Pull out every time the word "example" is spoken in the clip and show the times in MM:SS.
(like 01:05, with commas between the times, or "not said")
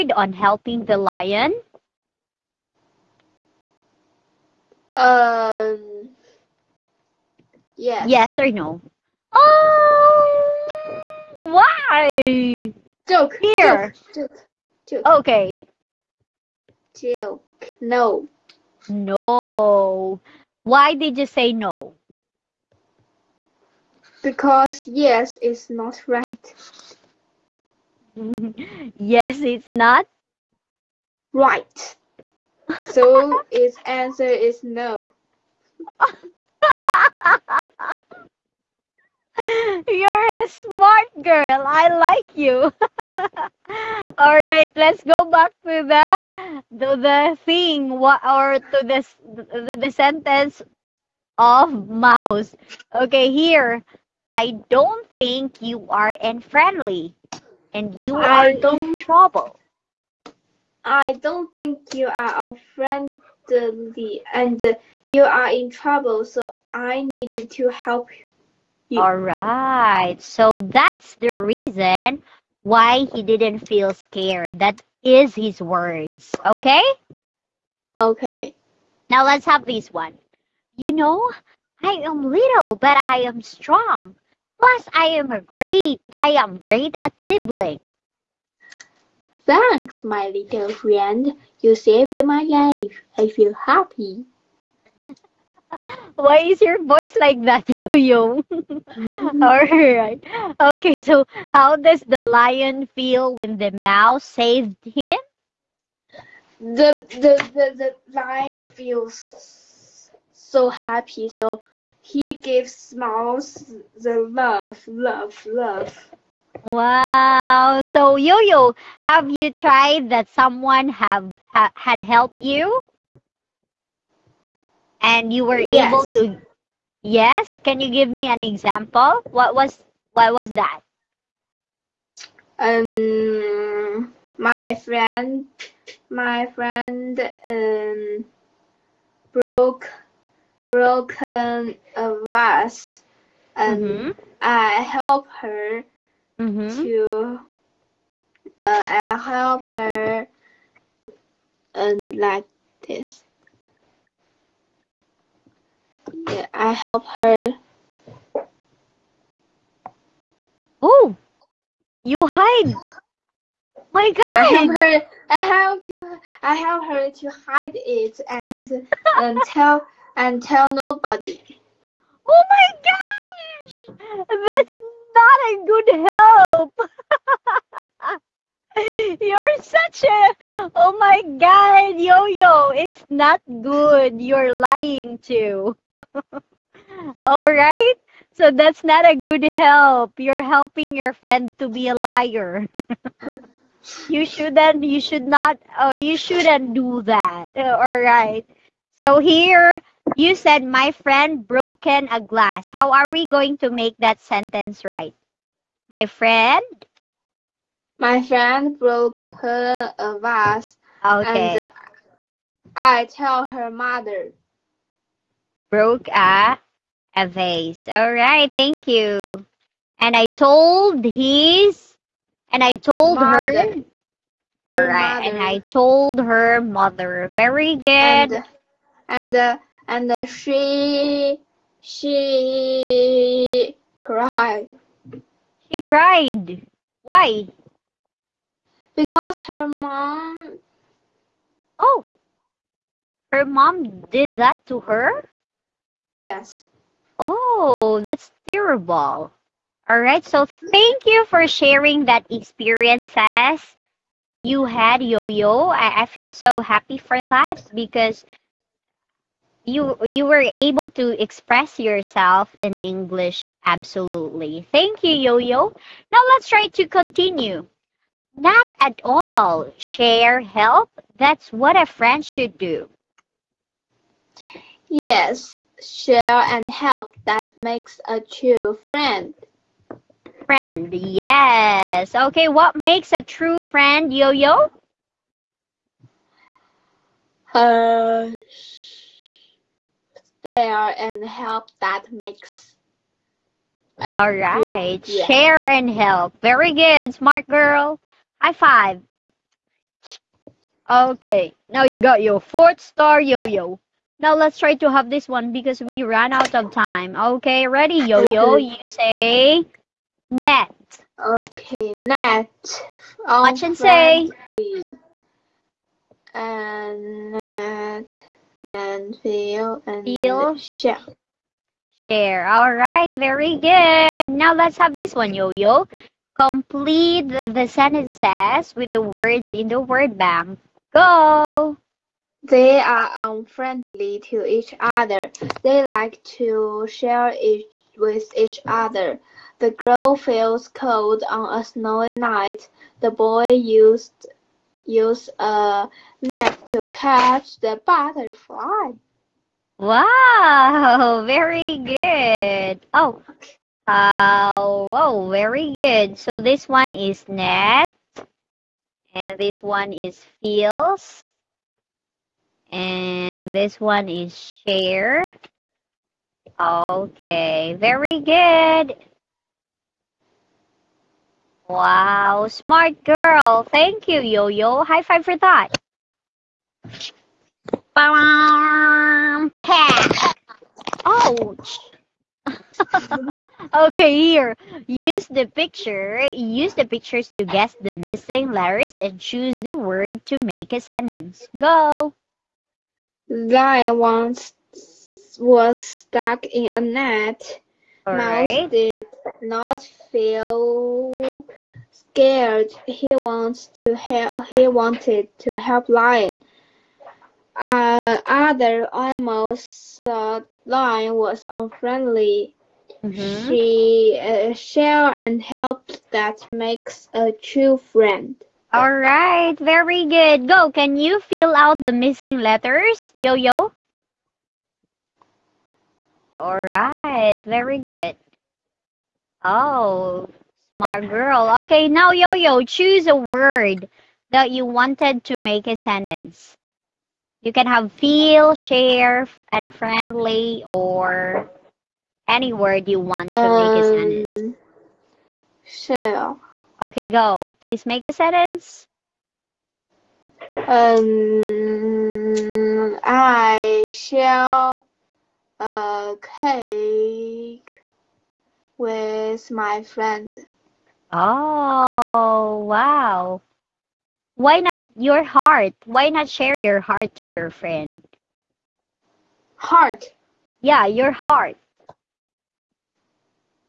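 02:08.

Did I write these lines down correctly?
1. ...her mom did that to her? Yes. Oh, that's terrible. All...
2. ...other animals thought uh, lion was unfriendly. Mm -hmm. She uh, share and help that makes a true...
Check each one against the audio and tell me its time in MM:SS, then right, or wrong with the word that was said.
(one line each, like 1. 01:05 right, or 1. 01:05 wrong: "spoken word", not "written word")
1. 04:03 right
2. 06:48 right.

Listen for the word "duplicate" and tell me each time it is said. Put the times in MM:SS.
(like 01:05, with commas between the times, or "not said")
not said.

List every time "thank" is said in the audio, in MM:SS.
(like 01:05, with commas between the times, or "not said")
01:29, 03:38, 04:10, 04:24, 06:13.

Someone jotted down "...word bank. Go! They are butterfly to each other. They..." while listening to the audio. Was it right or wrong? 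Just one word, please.
wrong.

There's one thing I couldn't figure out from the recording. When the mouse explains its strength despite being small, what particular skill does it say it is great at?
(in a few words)
Nibbling.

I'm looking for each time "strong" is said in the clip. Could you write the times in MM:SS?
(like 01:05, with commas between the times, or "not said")
01:23.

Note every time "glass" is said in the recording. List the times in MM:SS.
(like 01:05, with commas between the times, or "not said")
03:22.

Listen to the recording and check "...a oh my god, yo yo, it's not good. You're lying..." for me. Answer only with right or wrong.
right.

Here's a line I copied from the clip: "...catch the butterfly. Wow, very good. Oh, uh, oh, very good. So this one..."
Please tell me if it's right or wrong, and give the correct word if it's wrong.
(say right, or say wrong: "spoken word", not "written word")
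right.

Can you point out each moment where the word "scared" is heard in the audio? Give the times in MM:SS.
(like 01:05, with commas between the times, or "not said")
01:13, 06:41.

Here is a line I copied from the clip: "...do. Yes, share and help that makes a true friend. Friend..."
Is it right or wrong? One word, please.
right.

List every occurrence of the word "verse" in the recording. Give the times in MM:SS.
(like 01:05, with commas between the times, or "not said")
not said.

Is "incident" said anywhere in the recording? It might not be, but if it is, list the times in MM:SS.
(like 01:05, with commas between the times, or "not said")
not said.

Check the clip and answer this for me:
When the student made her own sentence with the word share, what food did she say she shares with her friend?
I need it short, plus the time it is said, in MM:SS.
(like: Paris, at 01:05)
Cake, at 07:36.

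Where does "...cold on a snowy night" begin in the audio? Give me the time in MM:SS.
05:40.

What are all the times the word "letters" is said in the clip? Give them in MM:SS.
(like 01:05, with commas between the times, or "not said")
06:28, 07:02.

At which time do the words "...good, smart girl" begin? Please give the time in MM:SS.
04:56.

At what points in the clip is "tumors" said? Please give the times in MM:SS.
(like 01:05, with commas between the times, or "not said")
not said.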